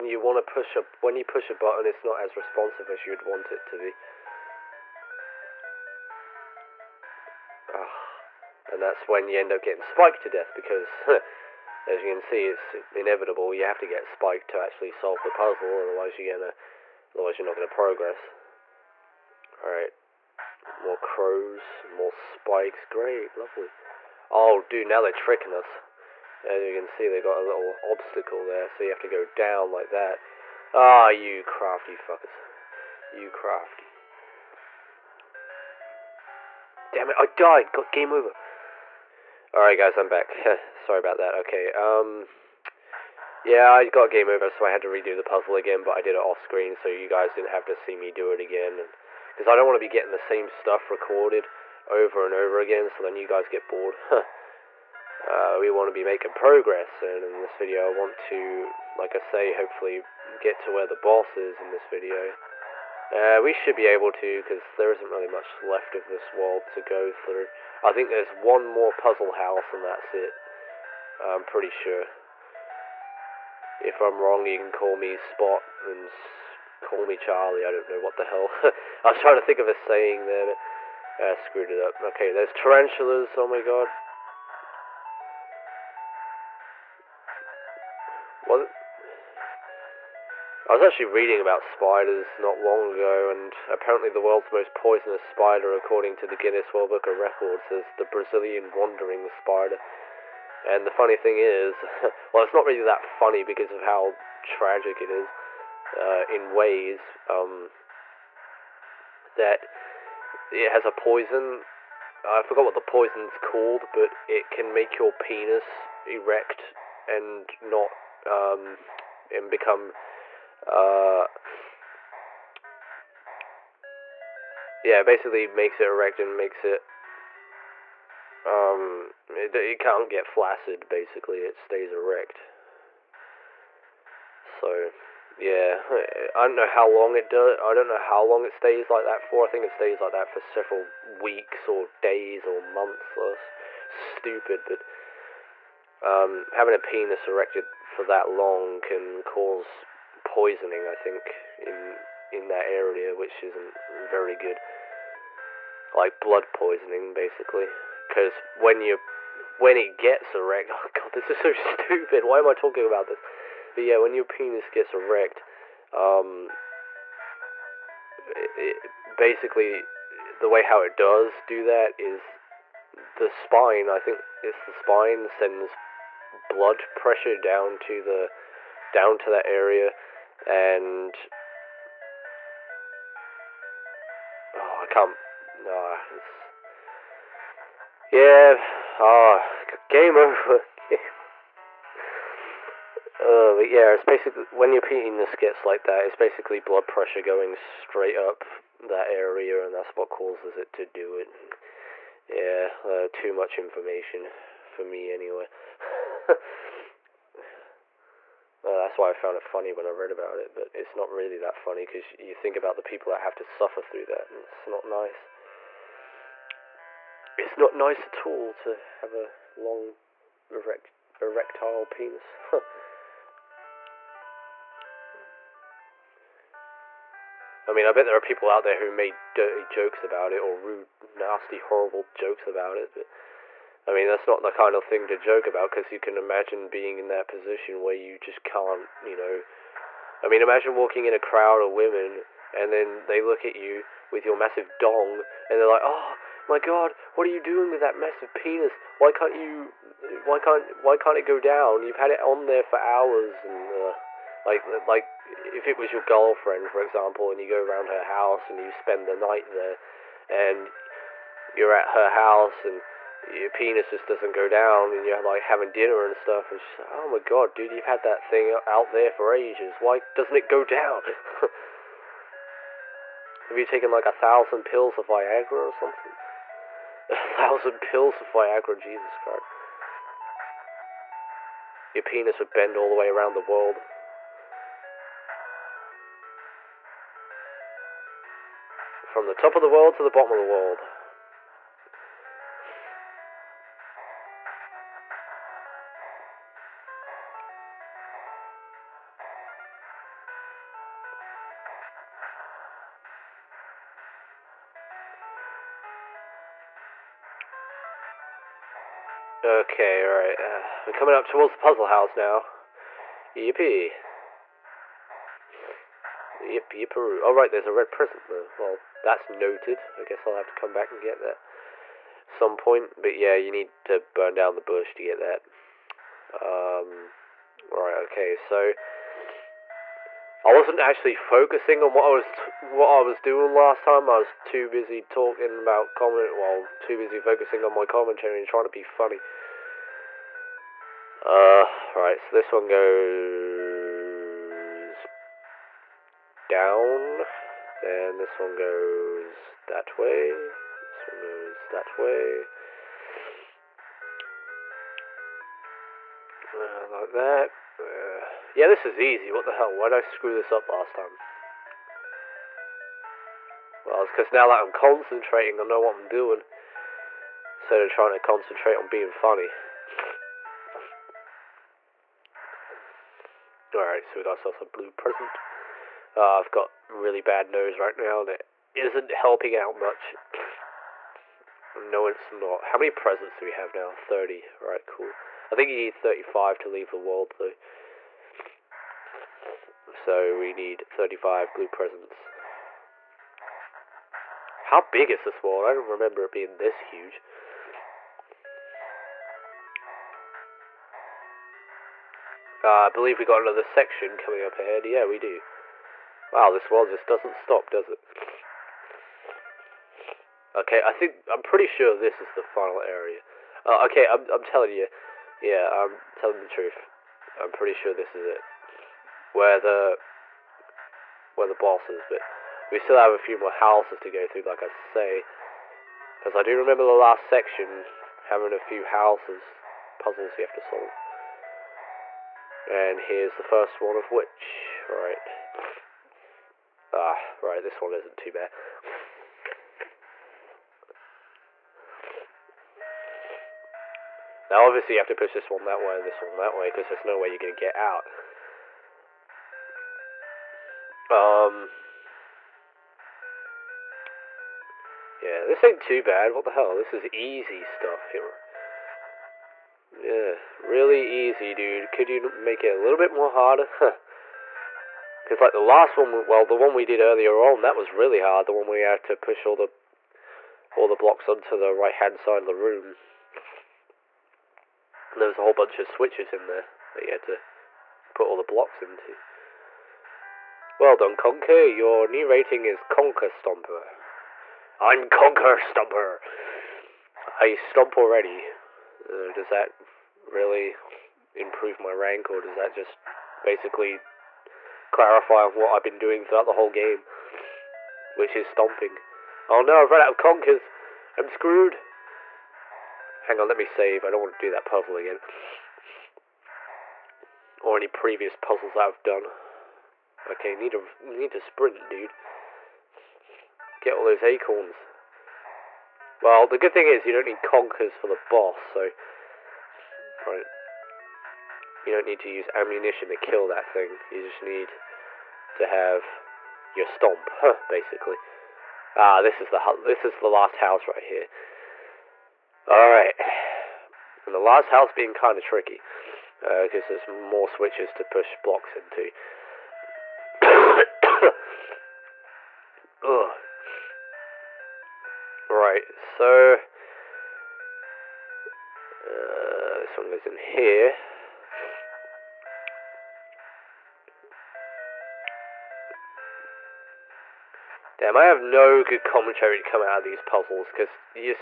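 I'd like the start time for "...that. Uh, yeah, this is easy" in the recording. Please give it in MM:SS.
05:57.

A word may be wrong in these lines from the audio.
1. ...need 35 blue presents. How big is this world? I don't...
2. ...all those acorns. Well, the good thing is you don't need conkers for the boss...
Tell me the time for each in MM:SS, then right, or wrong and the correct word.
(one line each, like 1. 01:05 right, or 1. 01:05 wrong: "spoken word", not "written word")
1. 06:30 right
2. 08:33 right.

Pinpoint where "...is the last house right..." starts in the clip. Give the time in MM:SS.
08:50.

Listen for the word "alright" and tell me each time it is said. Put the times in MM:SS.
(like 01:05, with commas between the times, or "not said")
00:19, 00:39, 05:10, 06:13.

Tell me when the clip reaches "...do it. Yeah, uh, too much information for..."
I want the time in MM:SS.
03:20.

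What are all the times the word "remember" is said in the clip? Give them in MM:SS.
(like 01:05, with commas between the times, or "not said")
06:35, 07:06.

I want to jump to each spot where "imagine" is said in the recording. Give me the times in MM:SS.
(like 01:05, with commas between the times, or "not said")
03:56, 04:00.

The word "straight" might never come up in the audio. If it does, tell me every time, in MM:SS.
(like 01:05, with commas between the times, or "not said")
03:17.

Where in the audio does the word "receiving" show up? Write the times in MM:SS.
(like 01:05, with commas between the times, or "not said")
not said.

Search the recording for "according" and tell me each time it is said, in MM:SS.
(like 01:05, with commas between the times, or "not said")
01:35.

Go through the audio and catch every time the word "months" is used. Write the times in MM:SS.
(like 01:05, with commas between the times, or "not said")
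02:22.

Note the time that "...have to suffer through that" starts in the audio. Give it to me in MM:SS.
03:33.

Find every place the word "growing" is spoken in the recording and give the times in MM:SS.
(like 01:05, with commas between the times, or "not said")
not said.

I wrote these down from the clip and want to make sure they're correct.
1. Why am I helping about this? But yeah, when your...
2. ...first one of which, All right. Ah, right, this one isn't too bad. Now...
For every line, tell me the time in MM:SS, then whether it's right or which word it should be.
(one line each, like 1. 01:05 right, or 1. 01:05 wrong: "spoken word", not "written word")
1. 02:42 wrong: "talking", not "helping"
2. 07:13 right.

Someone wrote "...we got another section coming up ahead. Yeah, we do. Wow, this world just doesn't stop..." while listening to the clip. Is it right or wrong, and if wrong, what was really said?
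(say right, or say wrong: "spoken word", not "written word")
right.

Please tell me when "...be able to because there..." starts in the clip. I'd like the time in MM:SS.
01:03.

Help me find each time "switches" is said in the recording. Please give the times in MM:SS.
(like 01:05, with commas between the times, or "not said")
07:55, 08:57.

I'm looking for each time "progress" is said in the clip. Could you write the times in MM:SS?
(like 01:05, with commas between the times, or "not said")
00:17, 00:56.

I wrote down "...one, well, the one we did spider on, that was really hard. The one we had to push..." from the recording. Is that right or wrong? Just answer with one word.
wrong.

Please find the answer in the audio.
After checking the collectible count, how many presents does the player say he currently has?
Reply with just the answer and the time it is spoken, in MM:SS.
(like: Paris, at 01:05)
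30, at 06:23.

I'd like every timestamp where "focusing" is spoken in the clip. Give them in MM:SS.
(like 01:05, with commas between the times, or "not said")
05:31, 05:37.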